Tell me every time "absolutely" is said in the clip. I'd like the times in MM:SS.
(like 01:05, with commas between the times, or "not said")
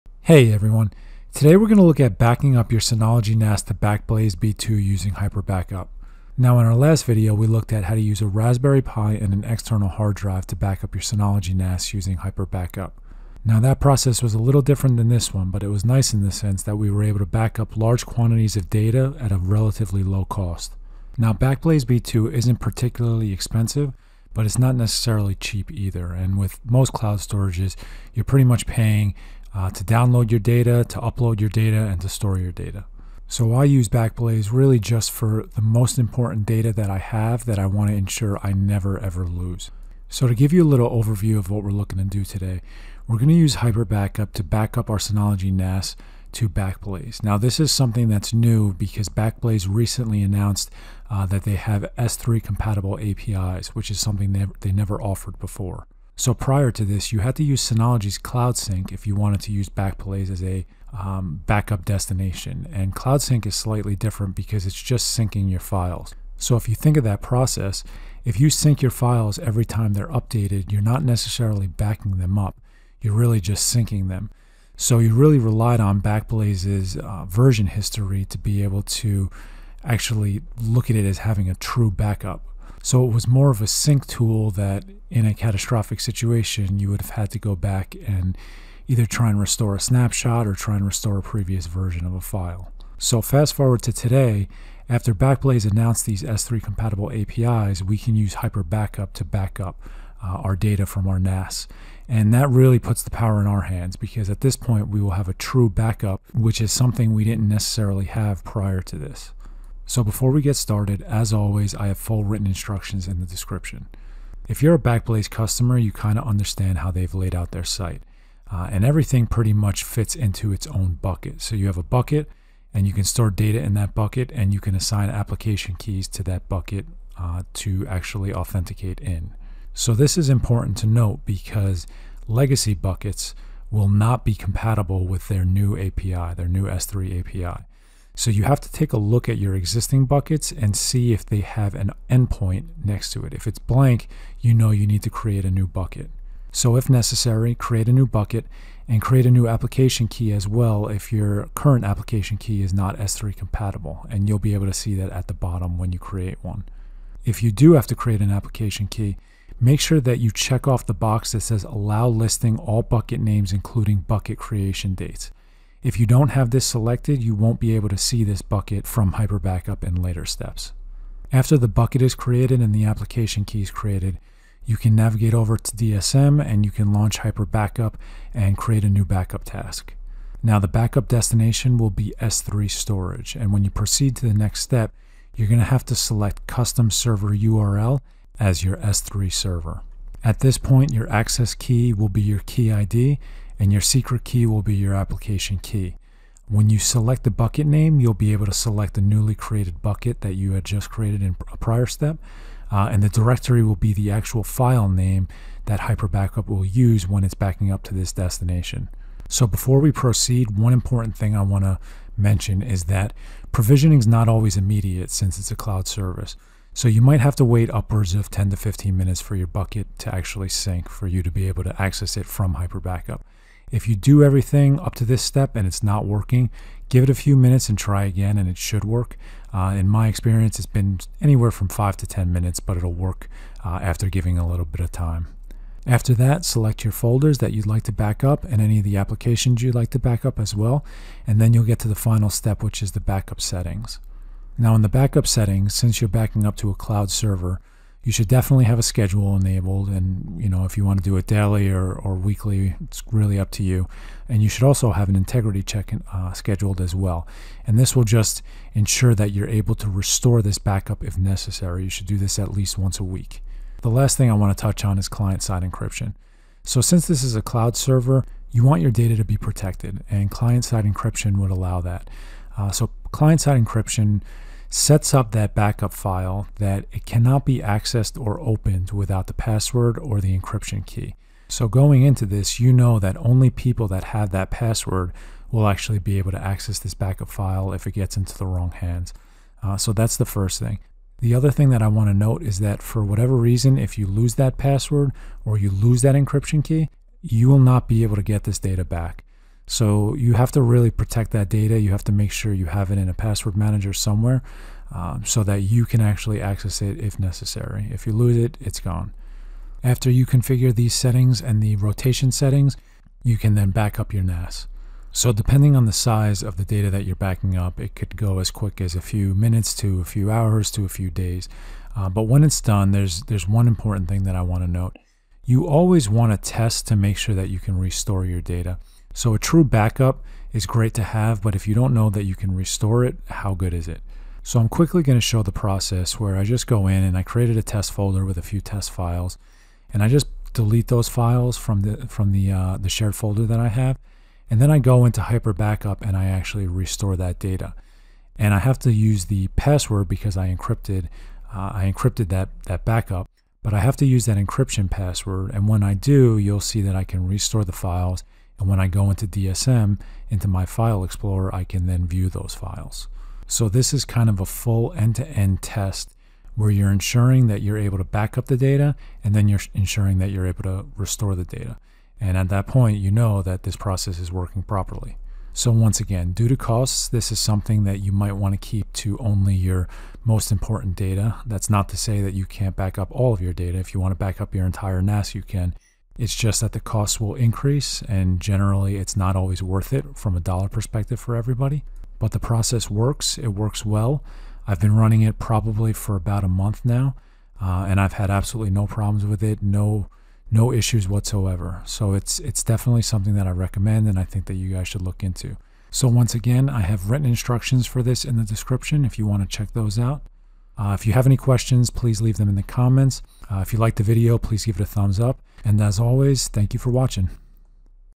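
06:38.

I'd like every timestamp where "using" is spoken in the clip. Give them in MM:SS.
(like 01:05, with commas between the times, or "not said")
00:04, 00:11.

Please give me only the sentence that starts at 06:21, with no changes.
That's not to say that you can't back up all of your data.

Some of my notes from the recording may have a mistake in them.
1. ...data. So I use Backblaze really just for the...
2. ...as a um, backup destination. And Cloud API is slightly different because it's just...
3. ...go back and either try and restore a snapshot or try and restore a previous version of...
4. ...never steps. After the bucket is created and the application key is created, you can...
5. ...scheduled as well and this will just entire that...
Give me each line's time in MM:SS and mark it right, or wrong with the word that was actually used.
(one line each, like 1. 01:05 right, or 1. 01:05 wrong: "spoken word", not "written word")
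1. 00:32 right
2. 01:00 wrong: "Sync", not "API"
3. 01:27 right
4. 02:49 wrong: "later", not "never"
5. 04:16 wrong: "ensure", not "entire".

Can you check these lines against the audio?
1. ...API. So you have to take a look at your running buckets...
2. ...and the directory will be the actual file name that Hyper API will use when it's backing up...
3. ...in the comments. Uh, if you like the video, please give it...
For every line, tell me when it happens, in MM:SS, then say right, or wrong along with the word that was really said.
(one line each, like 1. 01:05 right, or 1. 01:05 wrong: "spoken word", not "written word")
1. 02:17 wrong: "existing", not "running"
2. 03:22 wrong: "Backup", not "API"
3. 06:52 right.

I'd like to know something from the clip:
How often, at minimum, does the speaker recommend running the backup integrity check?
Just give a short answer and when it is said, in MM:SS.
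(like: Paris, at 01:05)
once a week, at 04:22.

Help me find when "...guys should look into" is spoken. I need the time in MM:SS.
06:44.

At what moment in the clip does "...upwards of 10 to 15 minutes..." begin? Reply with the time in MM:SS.
03:37.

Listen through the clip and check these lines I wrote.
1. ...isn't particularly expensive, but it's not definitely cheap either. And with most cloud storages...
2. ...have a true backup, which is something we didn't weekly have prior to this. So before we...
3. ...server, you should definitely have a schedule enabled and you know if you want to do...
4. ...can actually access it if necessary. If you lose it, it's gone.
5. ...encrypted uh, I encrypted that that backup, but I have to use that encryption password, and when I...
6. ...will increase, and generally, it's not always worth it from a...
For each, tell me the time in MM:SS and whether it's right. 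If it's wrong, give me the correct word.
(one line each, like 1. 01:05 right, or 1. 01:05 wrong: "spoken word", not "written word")
1. 00:22 wrong: "necessarily", not "definitely"
2. 01:45 wrong: "necessarily", not "weekly"
3. 04:07 right
4. 05:05 right
5. 05:50 right
6. 06:27 right.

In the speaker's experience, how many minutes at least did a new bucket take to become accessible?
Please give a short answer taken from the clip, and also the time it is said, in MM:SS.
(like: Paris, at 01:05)
5, at 03:51.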